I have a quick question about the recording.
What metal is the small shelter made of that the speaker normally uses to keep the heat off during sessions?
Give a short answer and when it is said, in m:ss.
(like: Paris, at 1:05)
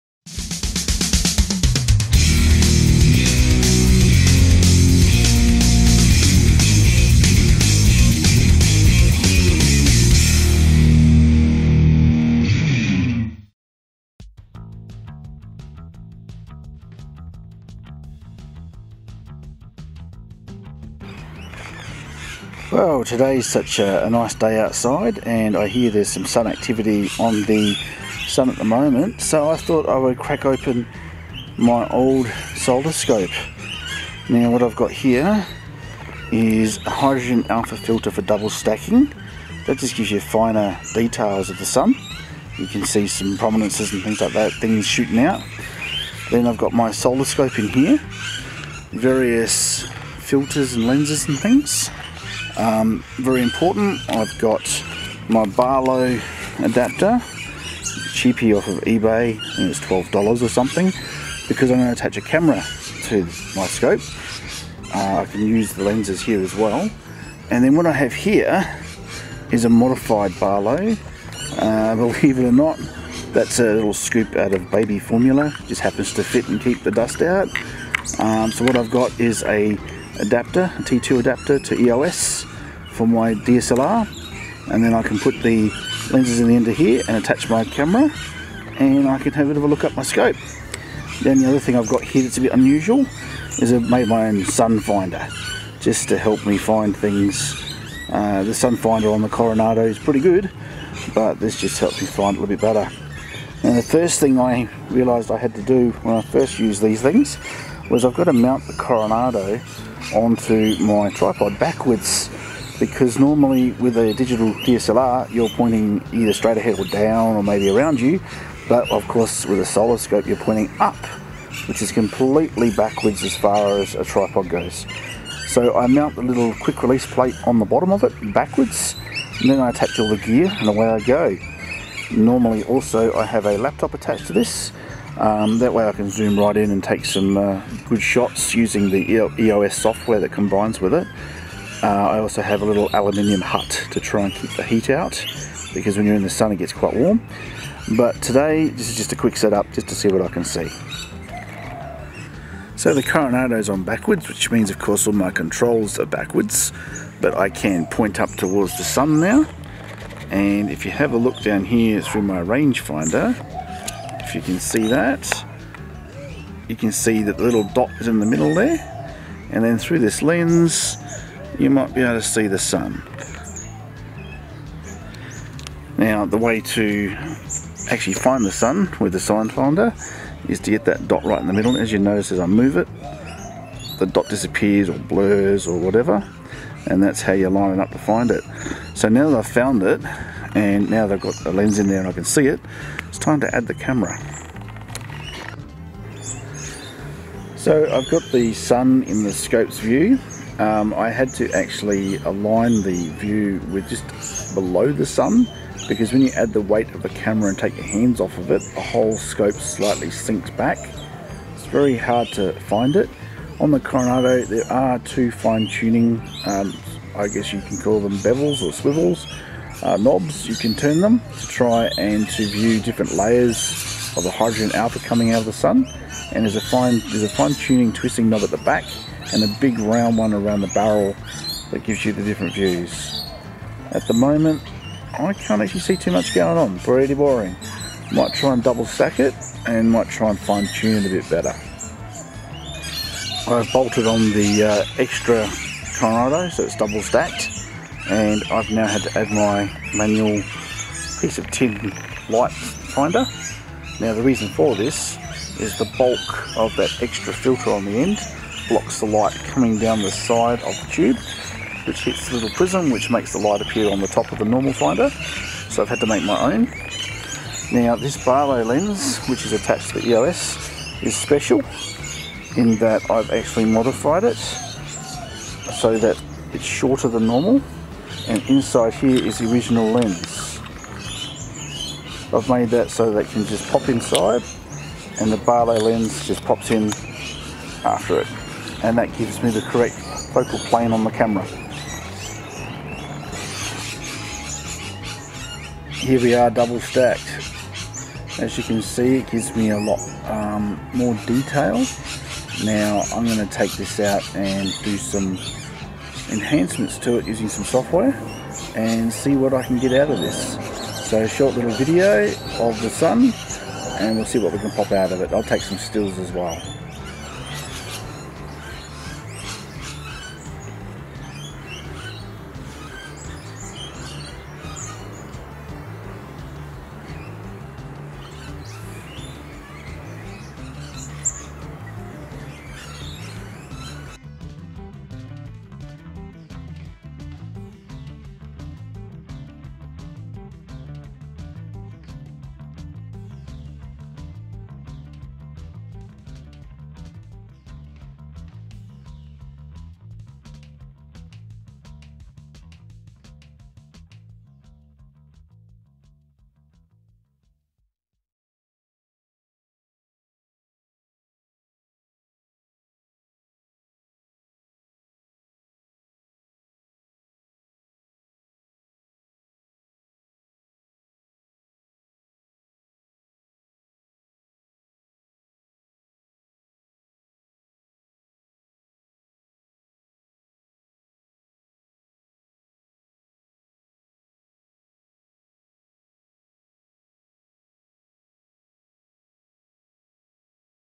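aluminium, at 2:22.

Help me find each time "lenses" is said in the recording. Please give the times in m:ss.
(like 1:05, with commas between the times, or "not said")
0:50, 1:05, 1:26.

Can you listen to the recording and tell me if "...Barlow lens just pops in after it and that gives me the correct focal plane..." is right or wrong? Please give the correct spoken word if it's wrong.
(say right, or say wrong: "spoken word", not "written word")
right.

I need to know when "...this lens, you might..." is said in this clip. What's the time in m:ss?
2:49.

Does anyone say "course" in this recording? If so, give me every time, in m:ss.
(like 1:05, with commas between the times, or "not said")
1:59, 2:34.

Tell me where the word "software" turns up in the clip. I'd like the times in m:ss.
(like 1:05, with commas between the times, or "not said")
2:19, 5:07.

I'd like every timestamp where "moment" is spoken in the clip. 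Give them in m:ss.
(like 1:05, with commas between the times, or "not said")
0:28, 3:54.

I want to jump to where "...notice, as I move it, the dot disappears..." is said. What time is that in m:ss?
3:01.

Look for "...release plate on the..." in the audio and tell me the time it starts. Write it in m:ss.
2:06.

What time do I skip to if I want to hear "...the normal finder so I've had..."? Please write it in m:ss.
4:24.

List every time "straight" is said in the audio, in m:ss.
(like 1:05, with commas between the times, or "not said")
1:56.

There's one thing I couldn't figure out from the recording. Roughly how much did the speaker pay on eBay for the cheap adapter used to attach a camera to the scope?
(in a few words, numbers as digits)
$12.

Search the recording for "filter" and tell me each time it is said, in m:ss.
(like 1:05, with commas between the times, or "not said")
0:37, 0:50, 4:17.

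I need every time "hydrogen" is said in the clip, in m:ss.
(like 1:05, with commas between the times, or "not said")
0:36, 3:44.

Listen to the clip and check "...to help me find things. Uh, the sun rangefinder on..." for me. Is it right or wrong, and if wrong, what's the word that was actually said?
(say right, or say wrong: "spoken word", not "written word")
wrong: "finder", not "rangefinder".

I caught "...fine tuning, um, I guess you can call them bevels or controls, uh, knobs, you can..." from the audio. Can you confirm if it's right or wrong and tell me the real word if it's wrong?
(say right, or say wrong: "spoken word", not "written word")
wrong: "swivels", not "controls".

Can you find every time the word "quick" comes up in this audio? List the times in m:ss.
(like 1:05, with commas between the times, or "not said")
2:06, 2:29.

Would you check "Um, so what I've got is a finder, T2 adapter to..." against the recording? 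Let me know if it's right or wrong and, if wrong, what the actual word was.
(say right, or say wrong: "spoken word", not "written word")
wrong: "adapter", not "finder".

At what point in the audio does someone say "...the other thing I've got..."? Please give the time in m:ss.
1:31.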